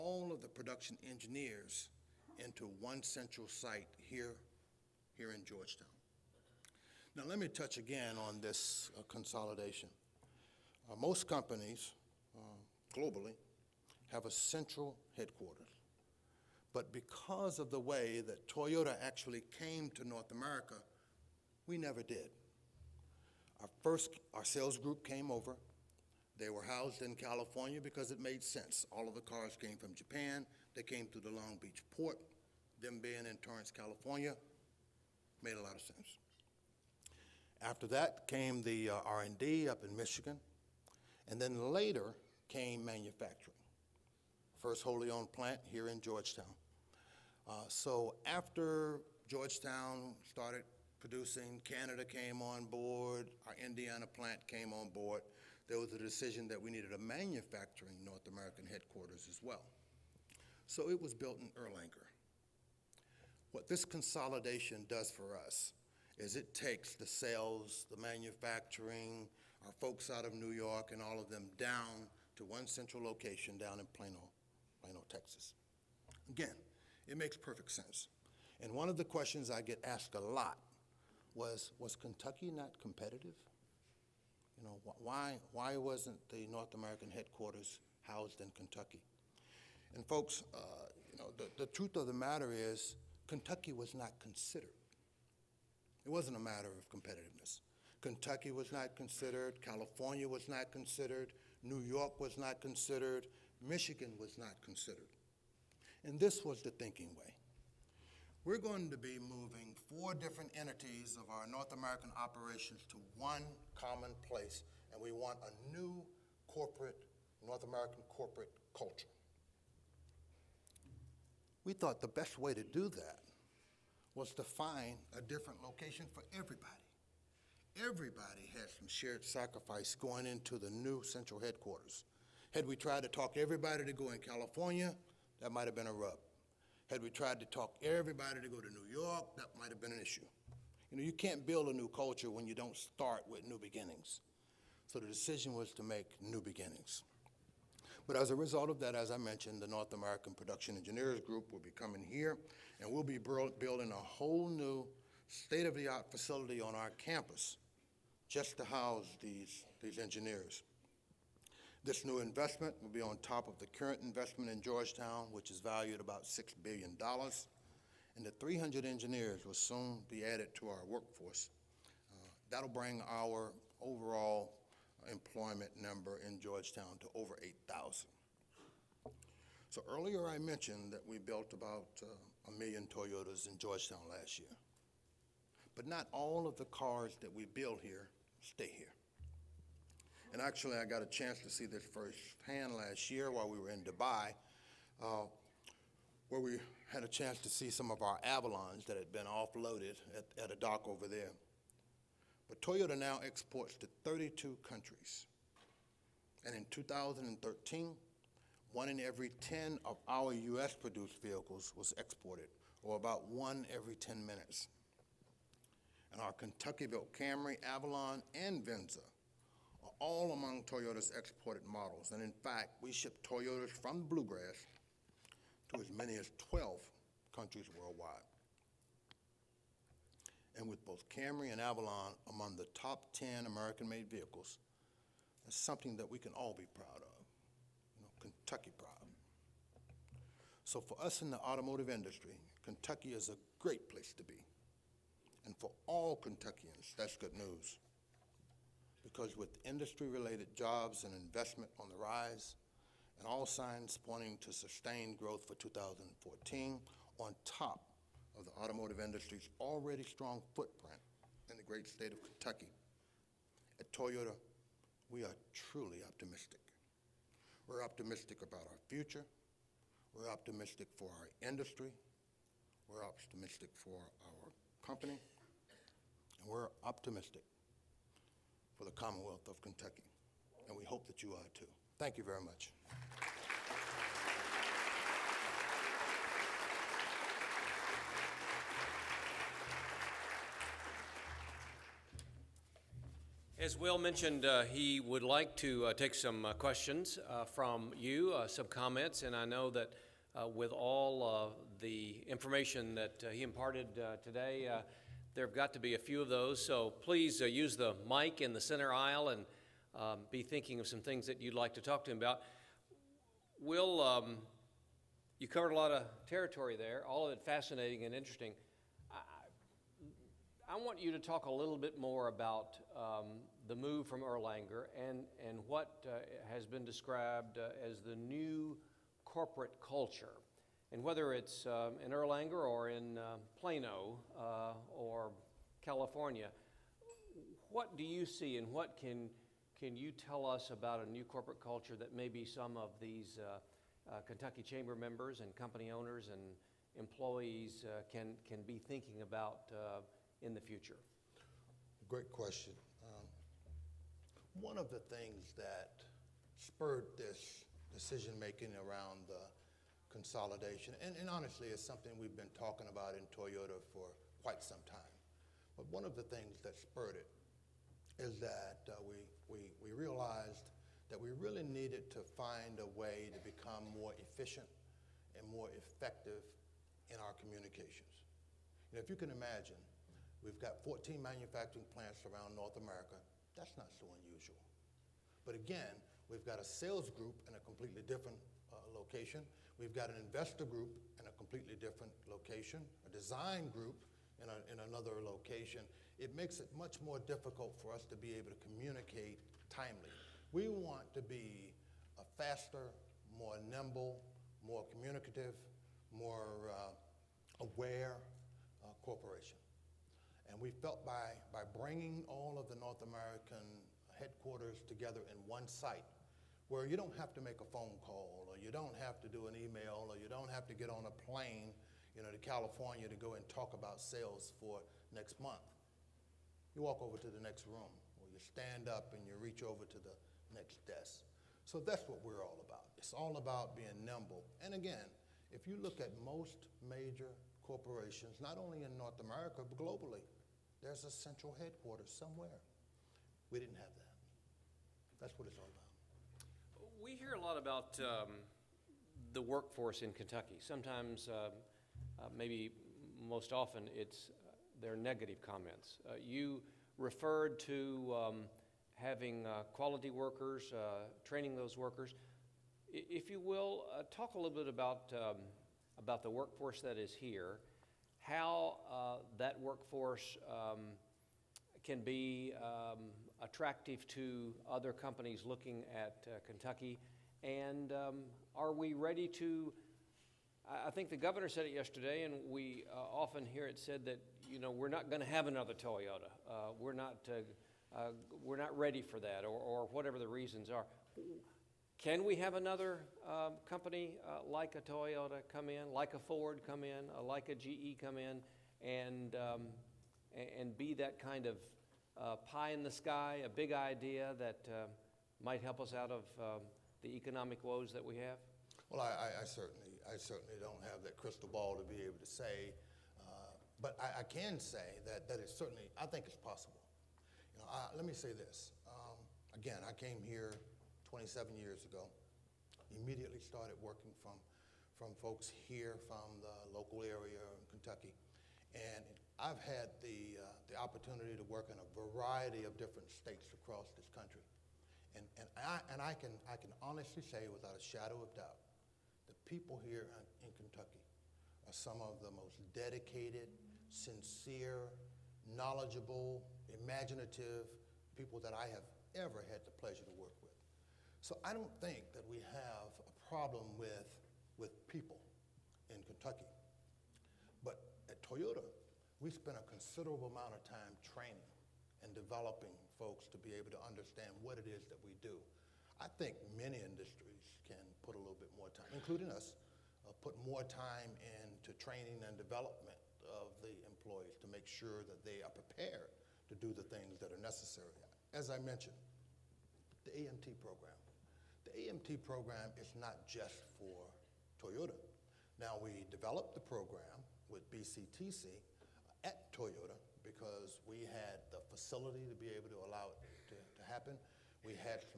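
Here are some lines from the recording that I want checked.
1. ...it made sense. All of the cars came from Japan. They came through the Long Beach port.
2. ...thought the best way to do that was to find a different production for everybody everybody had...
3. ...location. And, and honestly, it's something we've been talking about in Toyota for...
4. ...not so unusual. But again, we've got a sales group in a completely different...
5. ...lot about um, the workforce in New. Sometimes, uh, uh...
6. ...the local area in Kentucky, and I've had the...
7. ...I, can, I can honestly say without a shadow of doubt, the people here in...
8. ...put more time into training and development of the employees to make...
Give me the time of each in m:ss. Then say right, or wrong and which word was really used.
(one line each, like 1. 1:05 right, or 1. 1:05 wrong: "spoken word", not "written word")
1. 0:28 right
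2. 2:01 wrong: "location", not "production"
3. 6:00 wrong: "consolidation", not "location"
4. 6:23 right
5. 7:27 wrong: "Kentucky", not "New"
6. 8:46 right
7. 8:55 right
8. 9:30 right.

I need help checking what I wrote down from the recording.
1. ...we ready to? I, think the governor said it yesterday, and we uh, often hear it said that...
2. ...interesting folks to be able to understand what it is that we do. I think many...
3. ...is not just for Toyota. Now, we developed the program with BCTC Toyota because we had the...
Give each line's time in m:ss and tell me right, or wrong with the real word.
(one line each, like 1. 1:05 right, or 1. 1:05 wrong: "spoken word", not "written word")
1. 7:58 right
2. 9:22 wrong: "developing", not "interesting"
3. 9:42 right.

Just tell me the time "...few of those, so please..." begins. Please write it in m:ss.
5:05.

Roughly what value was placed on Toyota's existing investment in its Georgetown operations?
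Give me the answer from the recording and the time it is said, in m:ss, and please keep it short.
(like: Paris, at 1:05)
$6 billion, at 2:46.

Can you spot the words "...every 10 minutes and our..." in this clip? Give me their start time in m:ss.
3:33.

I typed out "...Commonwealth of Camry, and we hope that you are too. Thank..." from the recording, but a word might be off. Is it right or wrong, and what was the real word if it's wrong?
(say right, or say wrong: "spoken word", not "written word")
wrong: "Kentucky", not "Camry".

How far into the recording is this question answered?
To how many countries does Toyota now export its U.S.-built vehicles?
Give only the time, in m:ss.
3:24.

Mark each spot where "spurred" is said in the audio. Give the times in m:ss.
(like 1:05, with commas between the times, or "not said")
5:56, 6:06.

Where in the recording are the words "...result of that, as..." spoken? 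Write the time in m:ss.
2:28.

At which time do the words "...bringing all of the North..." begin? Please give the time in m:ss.
6:51.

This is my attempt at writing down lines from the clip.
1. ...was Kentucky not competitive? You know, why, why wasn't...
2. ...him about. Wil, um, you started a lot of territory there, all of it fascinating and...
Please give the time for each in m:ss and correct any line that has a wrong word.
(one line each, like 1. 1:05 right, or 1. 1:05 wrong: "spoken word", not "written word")
1. 1:21 right
2. 5:12 wrong: "covered", not "started".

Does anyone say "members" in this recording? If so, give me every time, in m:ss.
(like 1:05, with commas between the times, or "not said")
5:44.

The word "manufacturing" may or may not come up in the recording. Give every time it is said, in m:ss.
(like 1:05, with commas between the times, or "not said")
0:42, 0:56, 1:07, 6:21.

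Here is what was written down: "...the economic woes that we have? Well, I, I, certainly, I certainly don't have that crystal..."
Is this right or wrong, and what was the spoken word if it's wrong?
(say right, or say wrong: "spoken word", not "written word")
right.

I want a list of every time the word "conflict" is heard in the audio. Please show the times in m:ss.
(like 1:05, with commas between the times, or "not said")
not said.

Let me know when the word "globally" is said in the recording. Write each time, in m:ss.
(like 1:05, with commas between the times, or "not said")
0:12, 7:19.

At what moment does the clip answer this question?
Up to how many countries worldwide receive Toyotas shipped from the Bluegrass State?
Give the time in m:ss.
3:46.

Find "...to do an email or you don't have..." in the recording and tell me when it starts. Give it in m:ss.
6:59.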